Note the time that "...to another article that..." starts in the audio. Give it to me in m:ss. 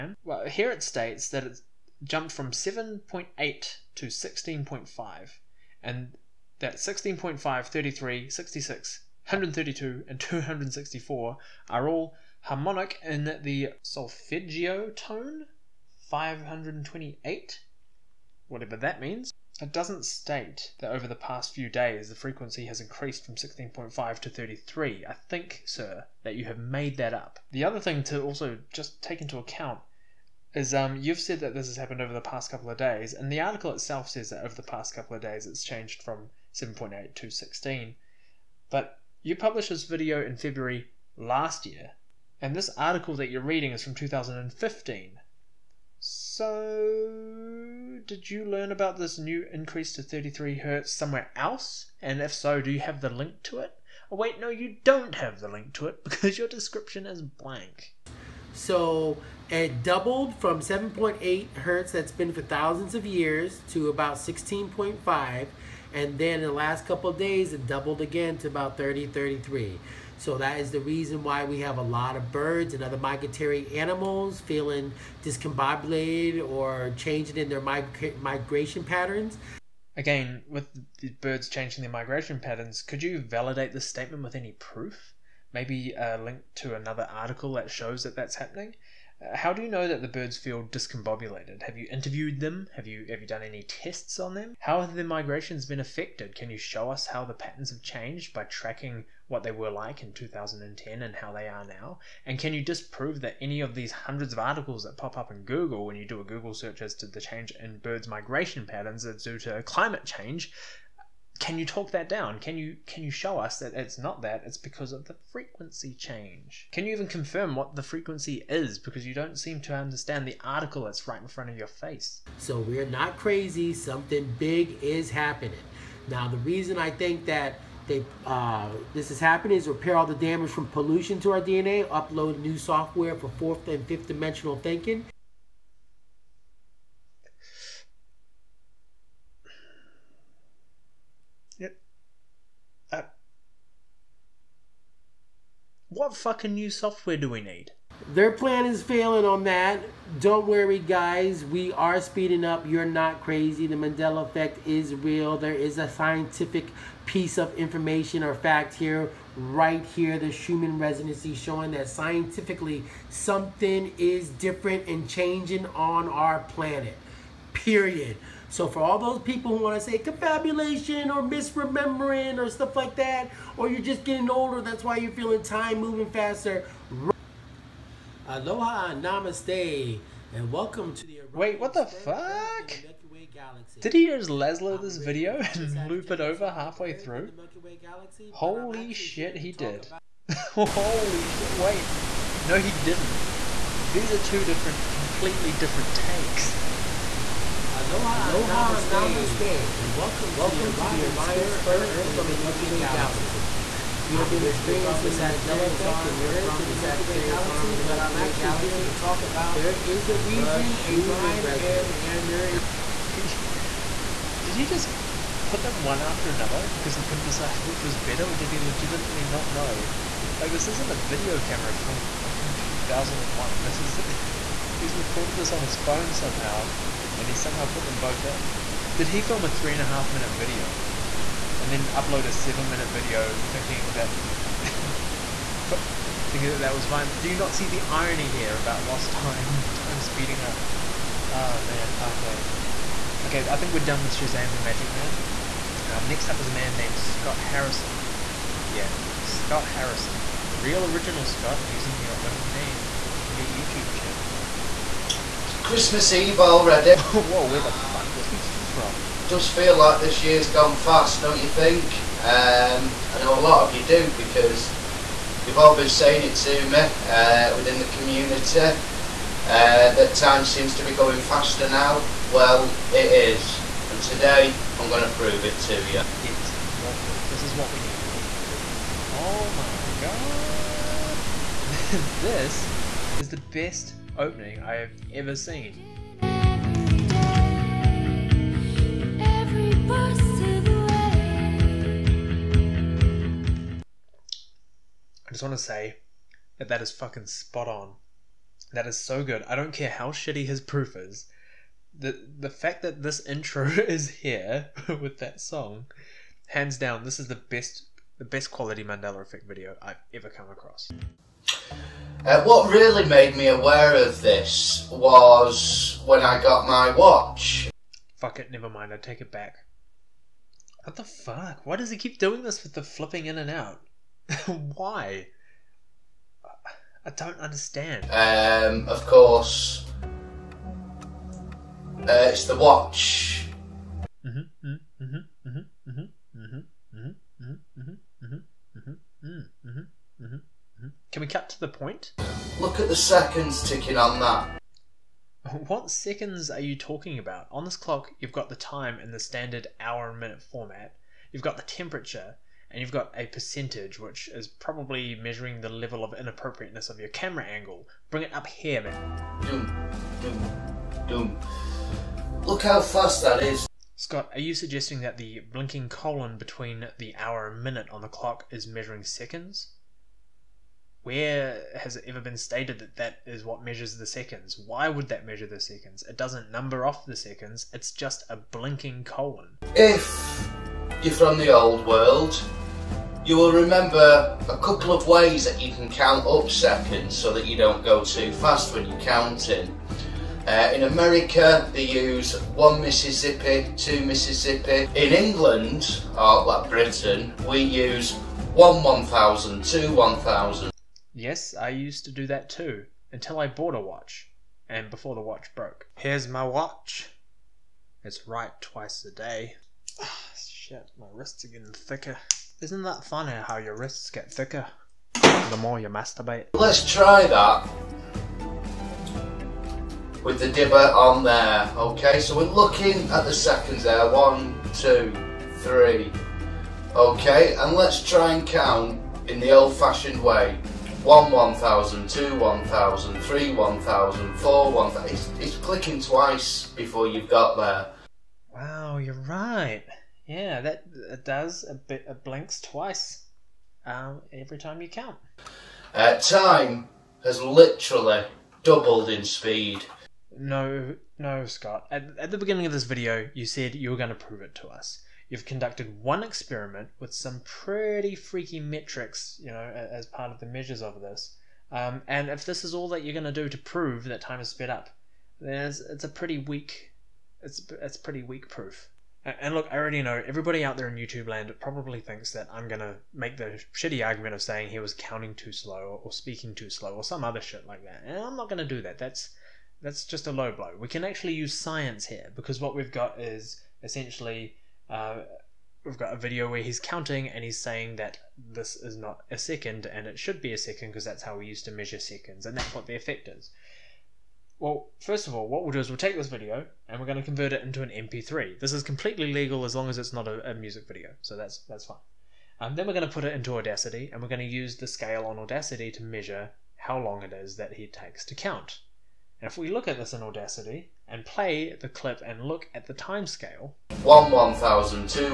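1:26.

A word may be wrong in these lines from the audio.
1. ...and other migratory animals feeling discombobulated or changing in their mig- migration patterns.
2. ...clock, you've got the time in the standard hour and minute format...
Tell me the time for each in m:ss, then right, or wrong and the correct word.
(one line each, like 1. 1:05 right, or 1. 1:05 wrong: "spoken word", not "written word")
1. 1:12 right
2. 5:47 right.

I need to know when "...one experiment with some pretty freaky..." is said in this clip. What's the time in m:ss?
7:36.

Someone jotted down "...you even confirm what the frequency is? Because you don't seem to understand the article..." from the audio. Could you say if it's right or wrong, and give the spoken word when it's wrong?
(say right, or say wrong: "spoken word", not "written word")
right.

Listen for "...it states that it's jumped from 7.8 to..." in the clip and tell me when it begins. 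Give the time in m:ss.
0:00.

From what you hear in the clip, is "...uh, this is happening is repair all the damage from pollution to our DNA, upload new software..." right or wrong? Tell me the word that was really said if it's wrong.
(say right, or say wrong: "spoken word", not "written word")
right.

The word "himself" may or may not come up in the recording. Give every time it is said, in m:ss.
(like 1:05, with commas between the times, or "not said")
not said.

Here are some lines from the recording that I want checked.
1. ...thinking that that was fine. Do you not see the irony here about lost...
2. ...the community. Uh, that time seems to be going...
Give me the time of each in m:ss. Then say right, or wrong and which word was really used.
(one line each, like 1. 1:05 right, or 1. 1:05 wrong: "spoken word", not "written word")
1. 3:56 right
2. 4:27 right.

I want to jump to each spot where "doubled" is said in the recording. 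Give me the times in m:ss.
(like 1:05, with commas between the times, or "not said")
0:59, 1:07, 7:28.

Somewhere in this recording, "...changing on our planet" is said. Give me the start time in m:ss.
2:45.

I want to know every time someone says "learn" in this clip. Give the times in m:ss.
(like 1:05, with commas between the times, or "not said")
0:48.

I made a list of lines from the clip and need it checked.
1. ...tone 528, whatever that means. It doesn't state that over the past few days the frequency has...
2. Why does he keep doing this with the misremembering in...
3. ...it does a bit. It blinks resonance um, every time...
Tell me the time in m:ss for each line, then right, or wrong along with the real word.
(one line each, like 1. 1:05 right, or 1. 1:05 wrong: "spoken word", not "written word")
1. 0:14 right
2. 5:21 wrong: "flipping", not "misremembering"
3. 7:21 wrong: "twice", not "resonance".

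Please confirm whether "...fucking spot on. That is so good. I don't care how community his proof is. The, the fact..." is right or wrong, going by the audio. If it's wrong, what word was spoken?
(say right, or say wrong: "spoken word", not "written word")
wrong: "shitty", not "community".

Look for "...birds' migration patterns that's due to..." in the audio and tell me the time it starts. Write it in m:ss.
1:47.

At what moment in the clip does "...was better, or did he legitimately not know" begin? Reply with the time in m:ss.
3:37.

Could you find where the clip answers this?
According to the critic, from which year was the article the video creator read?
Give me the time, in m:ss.
0:43.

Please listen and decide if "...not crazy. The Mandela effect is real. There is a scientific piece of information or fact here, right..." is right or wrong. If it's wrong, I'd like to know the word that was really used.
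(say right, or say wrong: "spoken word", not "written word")
right.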